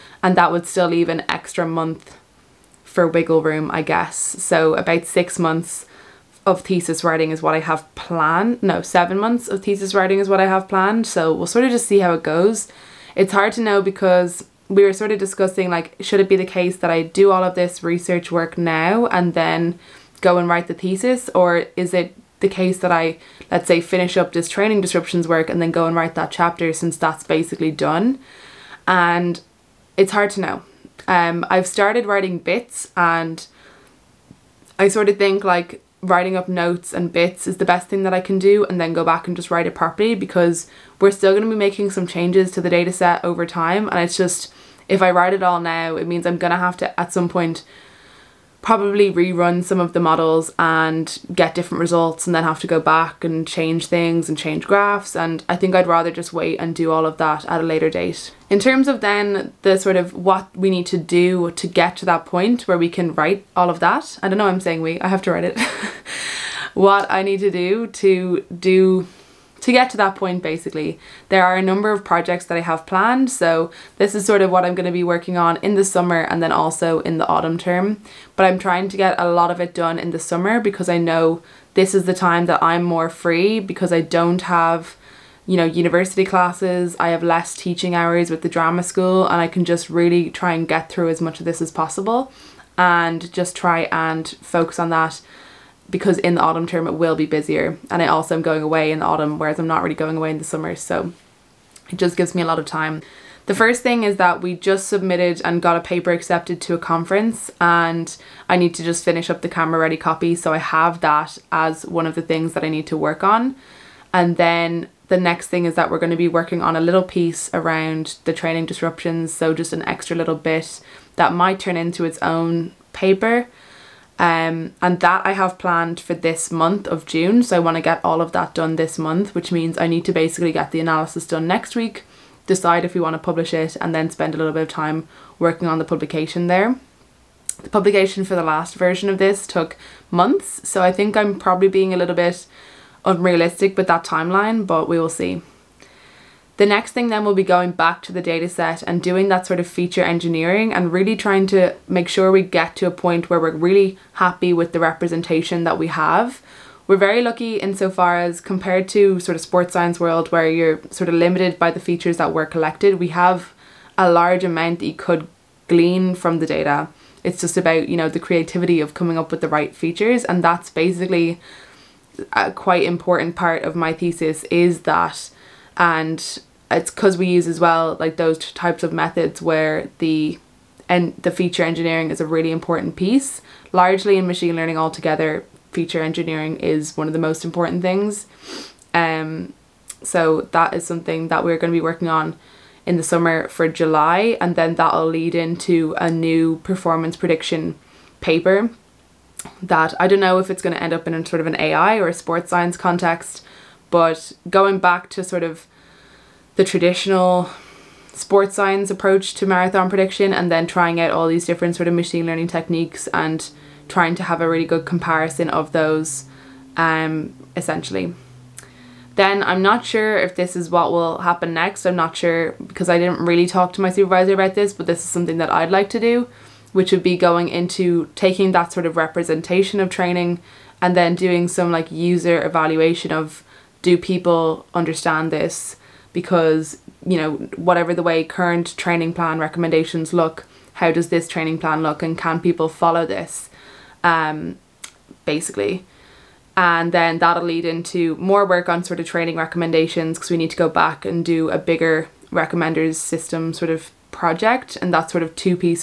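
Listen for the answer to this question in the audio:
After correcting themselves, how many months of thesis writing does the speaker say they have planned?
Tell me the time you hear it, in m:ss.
0:08.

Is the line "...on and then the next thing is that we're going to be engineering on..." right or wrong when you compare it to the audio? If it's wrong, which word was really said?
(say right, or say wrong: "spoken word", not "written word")
wrong: "working", not "engineering".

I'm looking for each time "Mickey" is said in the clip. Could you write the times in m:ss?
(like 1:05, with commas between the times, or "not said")
not said.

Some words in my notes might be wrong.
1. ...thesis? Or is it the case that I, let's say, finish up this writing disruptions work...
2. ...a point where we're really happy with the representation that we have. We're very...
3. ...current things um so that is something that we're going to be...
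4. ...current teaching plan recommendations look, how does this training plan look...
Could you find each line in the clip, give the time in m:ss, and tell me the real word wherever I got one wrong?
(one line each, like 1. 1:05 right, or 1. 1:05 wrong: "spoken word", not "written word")
1. 0:20 wrong: "training", not "writing"
2. 2:32 right
3. 3:07 wrong: "important", not "current"
4. 3:58 wrong: "training", not "teaching".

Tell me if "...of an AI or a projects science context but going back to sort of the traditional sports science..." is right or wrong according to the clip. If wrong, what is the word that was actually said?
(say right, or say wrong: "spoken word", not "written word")
wrong: "sports", not "projects".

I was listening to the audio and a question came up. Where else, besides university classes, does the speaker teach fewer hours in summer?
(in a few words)
the drama school.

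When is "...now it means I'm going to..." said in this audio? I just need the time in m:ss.
0:45.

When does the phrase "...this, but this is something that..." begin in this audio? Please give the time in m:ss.
3:44.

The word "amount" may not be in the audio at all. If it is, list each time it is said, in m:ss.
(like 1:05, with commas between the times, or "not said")
2:44.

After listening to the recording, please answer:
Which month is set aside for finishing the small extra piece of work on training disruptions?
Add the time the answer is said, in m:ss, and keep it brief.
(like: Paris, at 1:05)
June, at 2:07.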